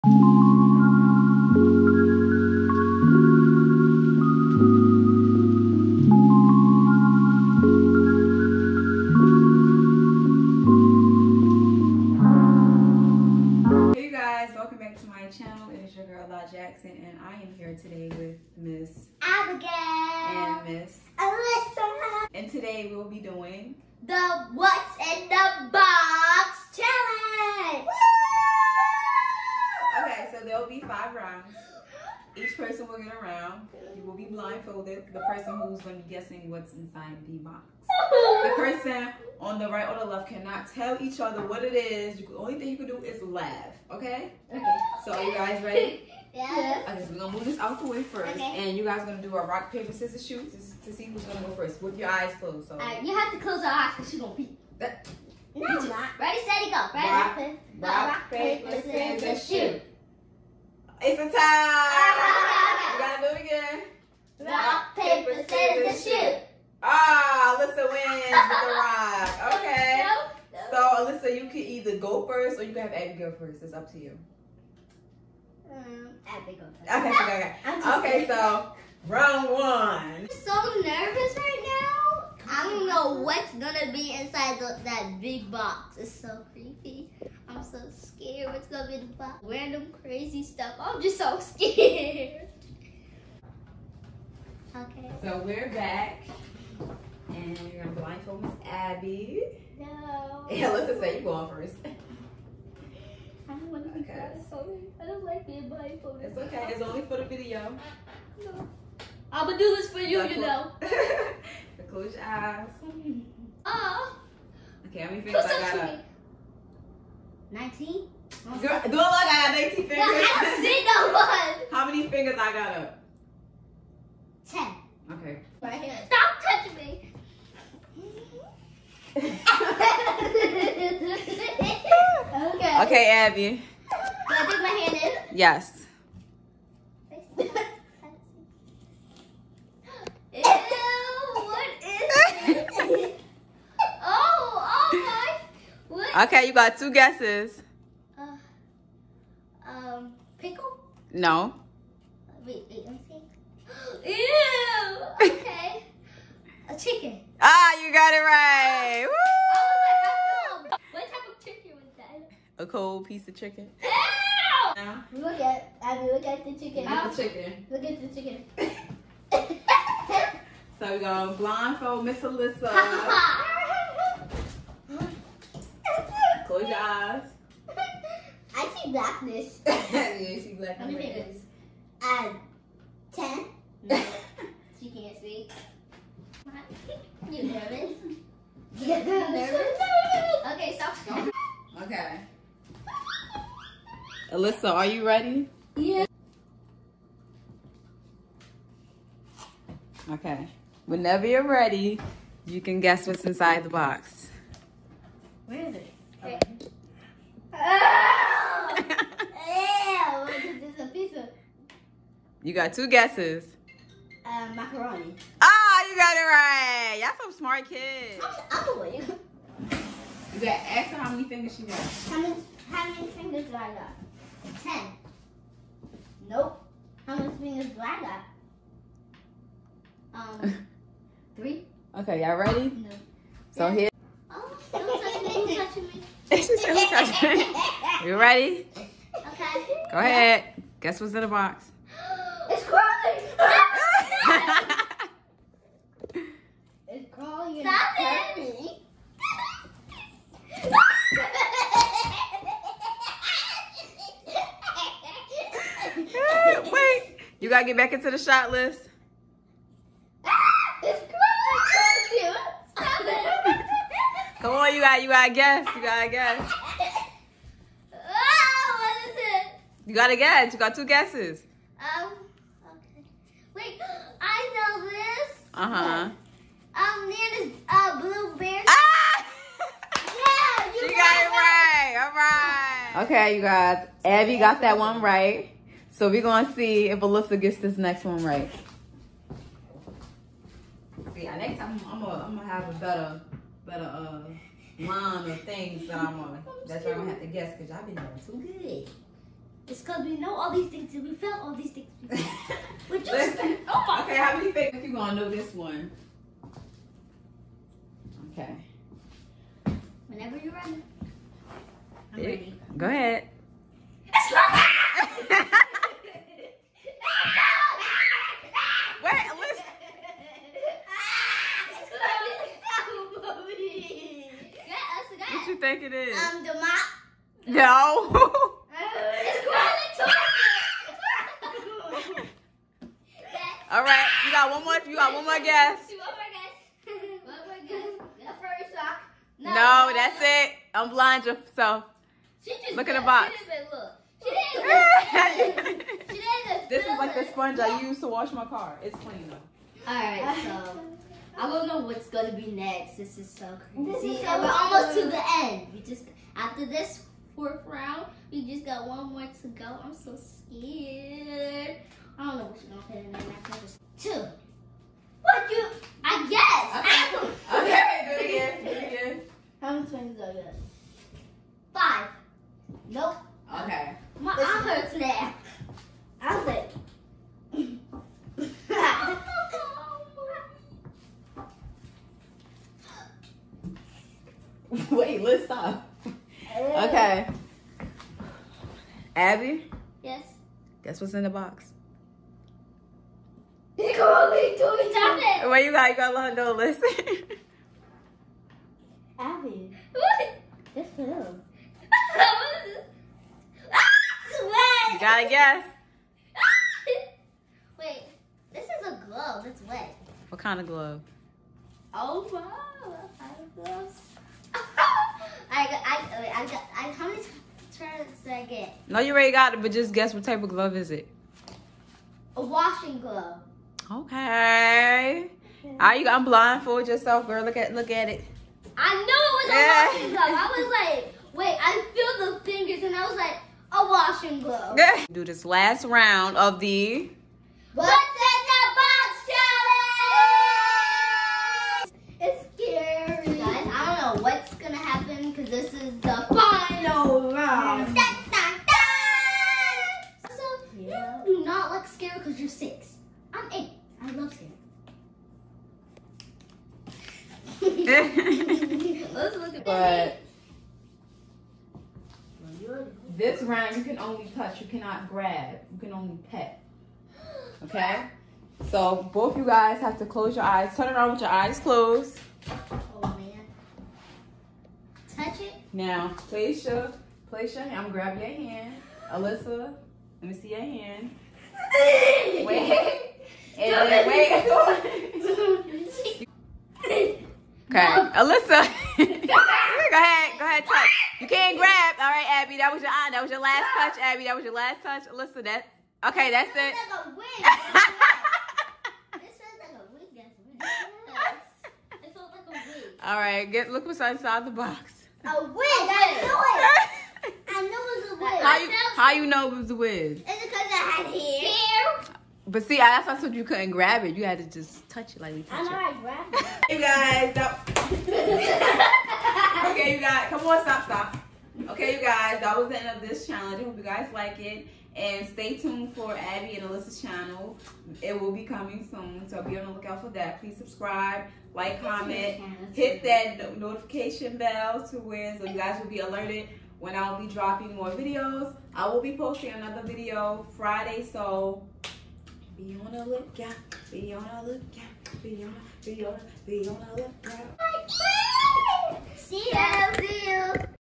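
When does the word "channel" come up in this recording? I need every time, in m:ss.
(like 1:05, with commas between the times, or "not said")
0:15, 8:47.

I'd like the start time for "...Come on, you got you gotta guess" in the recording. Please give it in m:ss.
4:24.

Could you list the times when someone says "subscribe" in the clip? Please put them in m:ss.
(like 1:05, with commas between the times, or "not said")
8:50.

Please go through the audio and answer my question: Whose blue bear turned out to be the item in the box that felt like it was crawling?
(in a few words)
Nana's.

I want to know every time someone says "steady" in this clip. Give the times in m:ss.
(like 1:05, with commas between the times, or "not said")
0:56.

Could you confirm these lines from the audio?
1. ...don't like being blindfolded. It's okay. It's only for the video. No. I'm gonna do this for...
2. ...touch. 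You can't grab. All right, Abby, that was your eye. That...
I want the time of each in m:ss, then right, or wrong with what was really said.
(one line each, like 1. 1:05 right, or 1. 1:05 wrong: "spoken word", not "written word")
1. 1:45 right
2. 8:10 right.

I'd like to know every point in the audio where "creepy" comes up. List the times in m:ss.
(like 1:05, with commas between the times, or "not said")
1:26.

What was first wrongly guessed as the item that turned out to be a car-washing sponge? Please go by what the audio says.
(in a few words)
the mop.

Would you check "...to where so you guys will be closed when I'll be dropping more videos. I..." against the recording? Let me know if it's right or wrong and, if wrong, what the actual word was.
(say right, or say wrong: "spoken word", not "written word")
wrong: "alerted", not "closed".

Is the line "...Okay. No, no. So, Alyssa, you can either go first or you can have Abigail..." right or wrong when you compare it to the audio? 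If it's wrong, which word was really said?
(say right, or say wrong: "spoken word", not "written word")
right.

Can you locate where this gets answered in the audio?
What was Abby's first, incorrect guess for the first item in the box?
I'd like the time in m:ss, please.
2:30.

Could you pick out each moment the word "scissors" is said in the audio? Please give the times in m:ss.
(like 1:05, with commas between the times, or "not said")
0:49, 0:59, 1:05.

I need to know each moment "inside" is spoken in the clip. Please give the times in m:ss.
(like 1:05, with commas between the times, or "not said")
0:36, 1:24, 3:23, 8:24.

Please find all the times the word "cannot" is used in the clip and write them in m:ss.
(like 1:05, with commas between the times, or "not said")
0:40, 7:44.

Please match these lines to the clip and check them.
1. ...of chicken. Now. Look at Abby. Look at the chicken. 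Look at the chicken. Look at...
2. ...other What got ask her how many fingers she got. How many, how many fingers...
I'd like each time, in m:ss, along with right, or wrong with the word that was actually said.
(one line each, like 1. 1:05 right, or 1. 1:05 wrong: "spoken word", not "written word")
1. 2:43 right
2. 3:38 wrong: "You", not "What".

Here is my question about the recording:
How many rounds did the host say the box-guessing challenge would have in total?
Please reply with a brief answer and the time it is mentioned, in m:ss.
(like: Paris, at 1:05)
5, at 0:30.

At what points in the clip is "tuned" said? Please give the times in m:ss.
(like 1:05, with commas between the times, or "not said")
8:45.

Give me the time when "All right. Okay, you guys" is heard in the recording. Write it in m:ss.
4:42.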